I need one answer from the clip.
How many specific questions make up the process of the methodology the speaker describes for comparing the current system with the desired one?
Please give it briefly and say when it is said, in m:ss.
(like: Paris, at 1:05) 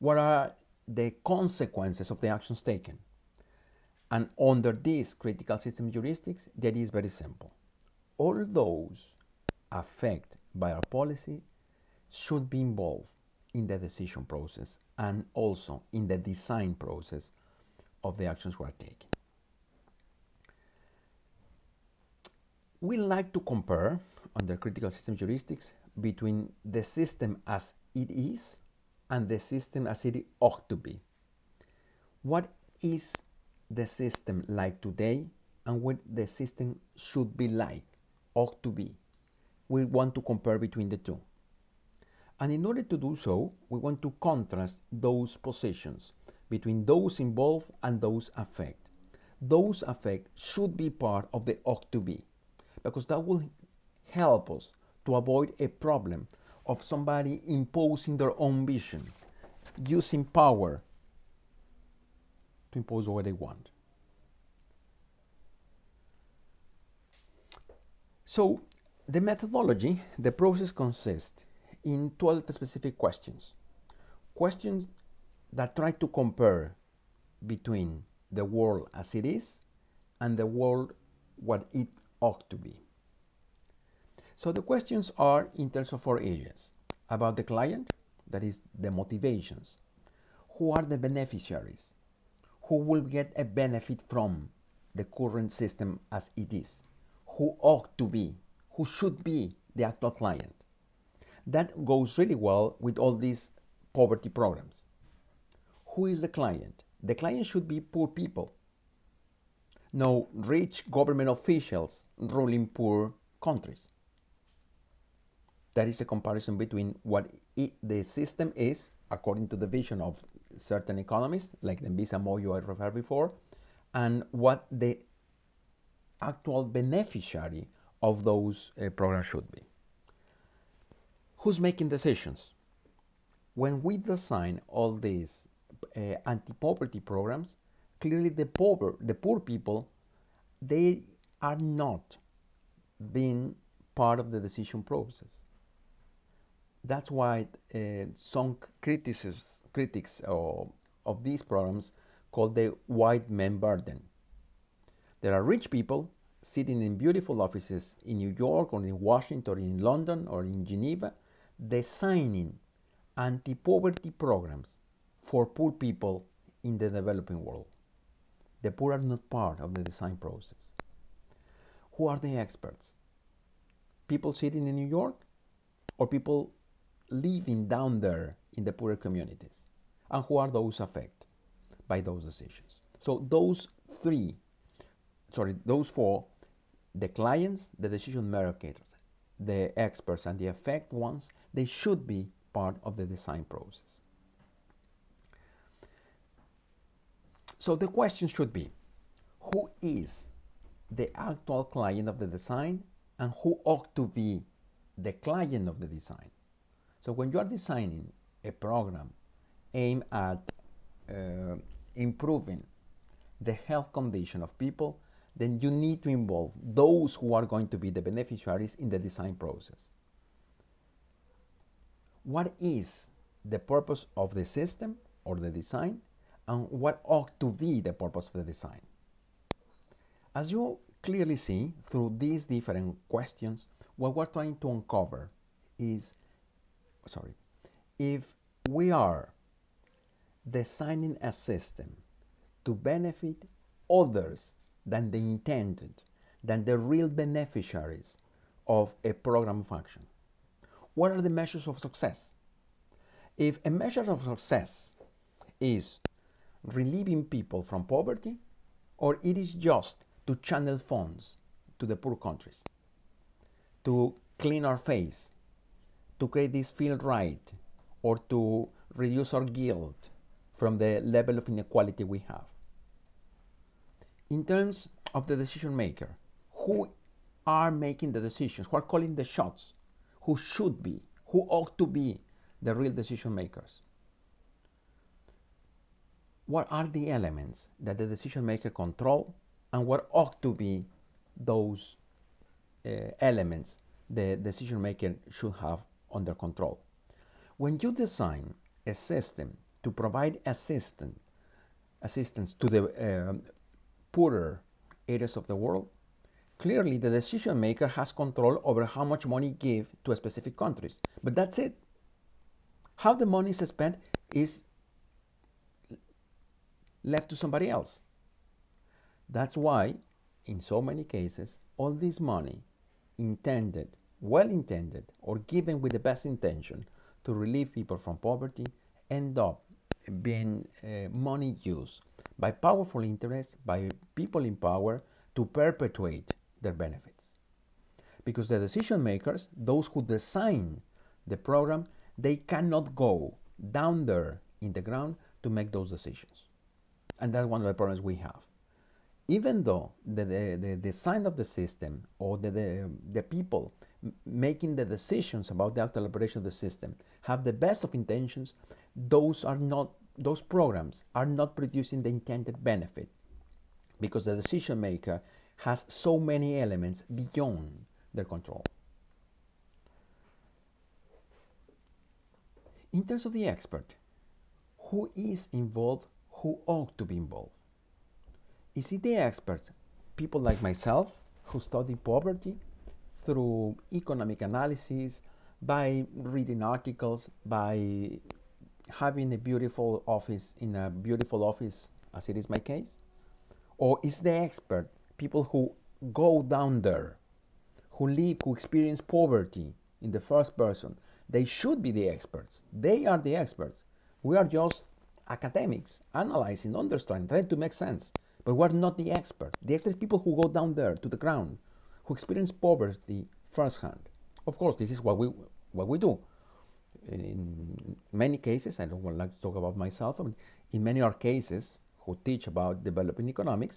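12, at 1:12.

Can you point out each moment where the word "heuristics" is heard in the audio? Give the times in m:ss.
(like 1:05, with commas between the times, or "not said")
0:05, 0:25.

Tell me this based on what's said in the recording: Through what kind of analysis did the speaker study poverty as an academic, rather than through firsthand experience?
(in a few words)
economic analysis.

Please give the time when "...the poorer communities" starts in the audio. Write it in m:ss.
2:58.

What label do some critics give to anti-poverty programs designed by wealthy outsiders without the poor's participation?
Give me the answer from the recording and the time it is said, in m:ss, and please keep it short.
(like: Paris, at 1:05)
white man burden, at 2:32.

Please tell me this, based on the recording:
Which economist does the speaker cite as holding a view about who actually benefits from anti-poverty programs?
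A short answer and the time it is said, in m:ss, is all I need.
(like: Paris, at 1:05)
Dambisa Moyo, at 2:01.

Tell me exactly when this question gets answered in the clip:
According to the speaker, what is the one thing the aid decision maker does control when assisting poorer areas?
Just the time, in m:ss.
5:08.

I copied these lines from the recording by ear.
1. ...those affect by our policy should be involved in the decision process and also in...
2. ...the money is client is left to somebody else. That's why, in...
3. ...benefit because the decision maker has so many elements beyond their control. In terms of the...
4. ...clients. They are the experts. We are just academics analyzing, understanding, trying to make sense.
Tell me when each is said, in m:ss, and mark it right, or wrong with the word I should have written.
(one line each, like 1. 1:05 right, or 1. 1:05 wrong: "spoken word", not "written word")
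1. 0:08 right
2. 5:13 wrong: "spent", not "client"
3. 6:02 right
4. 6:42 wrong: "experts", not "clients".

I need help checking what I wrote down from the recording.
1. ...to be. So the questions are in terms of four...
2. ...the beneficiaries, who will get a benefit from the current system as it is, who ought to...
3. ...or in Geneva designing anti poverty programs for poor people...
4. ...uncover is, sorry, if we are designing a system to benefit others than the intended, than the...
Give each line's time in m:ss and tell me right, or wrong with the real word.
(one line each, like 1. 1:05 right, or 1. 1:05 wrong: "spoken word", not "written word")
1. 1:22 right
2. 1:30 right
3. 2:40 right
4. 3:54 right.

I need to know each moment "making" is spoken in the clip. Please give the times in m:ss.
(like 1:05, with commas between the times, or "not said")
2:11, 4:37, 5:54.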